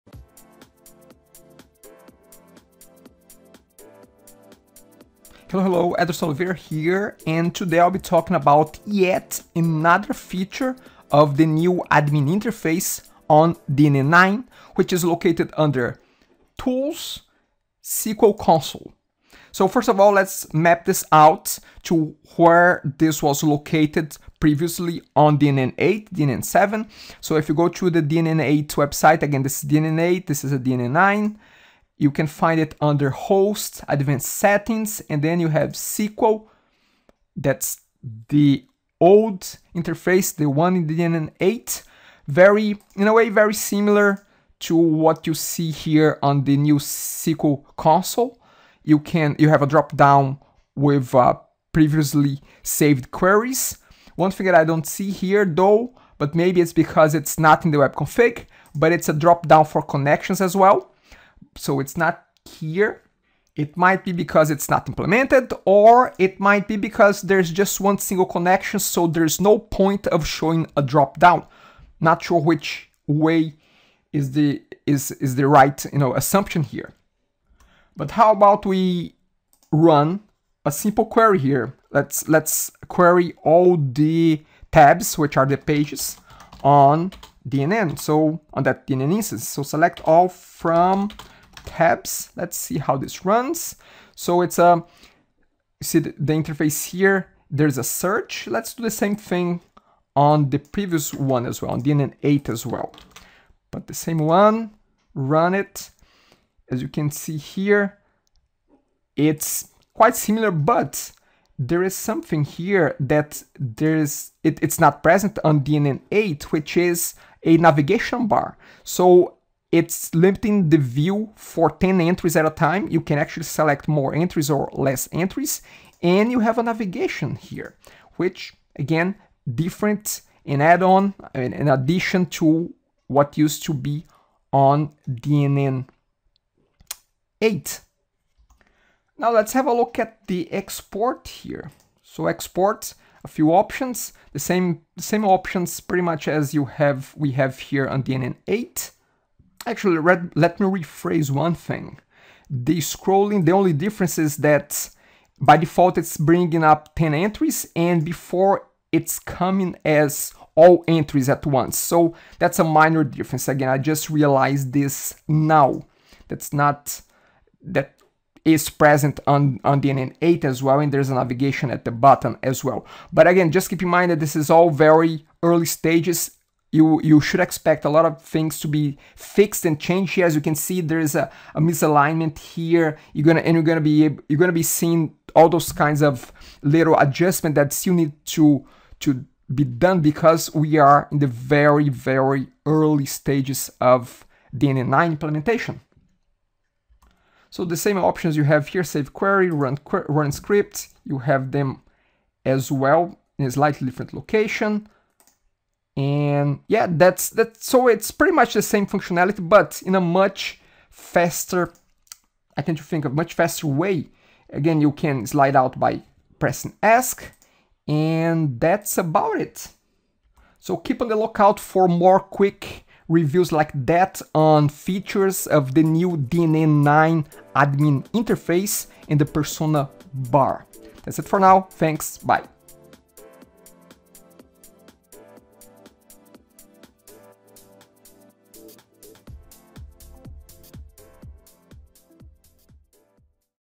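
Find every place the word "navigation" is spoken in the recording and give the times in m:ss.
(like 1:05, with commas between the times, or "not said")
1:57, 2:06, 2:51.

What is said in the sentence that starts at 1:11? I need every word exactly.
Not sure which way is the is is the right you know assumption here.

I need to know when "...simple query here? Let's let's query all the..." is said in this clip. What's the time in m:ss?
1:20.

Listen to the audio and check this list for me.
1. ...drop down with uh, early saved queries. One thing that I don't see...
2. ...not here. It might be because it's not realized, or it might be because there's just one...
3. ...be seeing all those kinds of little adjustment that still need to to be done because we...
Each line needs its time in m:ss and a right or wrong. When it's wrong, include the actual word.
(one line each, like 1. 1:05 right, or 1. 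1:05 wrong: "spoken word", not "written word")
1. 0:49 wrong: "previously", not "early"
2. 1:01 wrong: "implemented", not "realized"
3. 3:04 right.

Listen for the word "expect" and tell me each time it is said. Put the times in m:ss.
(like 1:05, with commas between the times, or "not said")
2:57.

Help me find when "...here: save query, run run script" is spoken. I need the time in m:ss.
3:18.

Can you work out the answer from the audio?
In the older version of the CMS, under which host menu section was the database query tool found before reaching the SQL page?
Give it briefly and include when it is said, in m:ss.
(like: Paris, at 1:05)
Advanced settings, at 0:33.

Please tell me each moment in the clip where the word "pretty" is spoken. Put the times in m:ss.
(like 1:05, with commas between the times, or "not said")
2:25, 3:28.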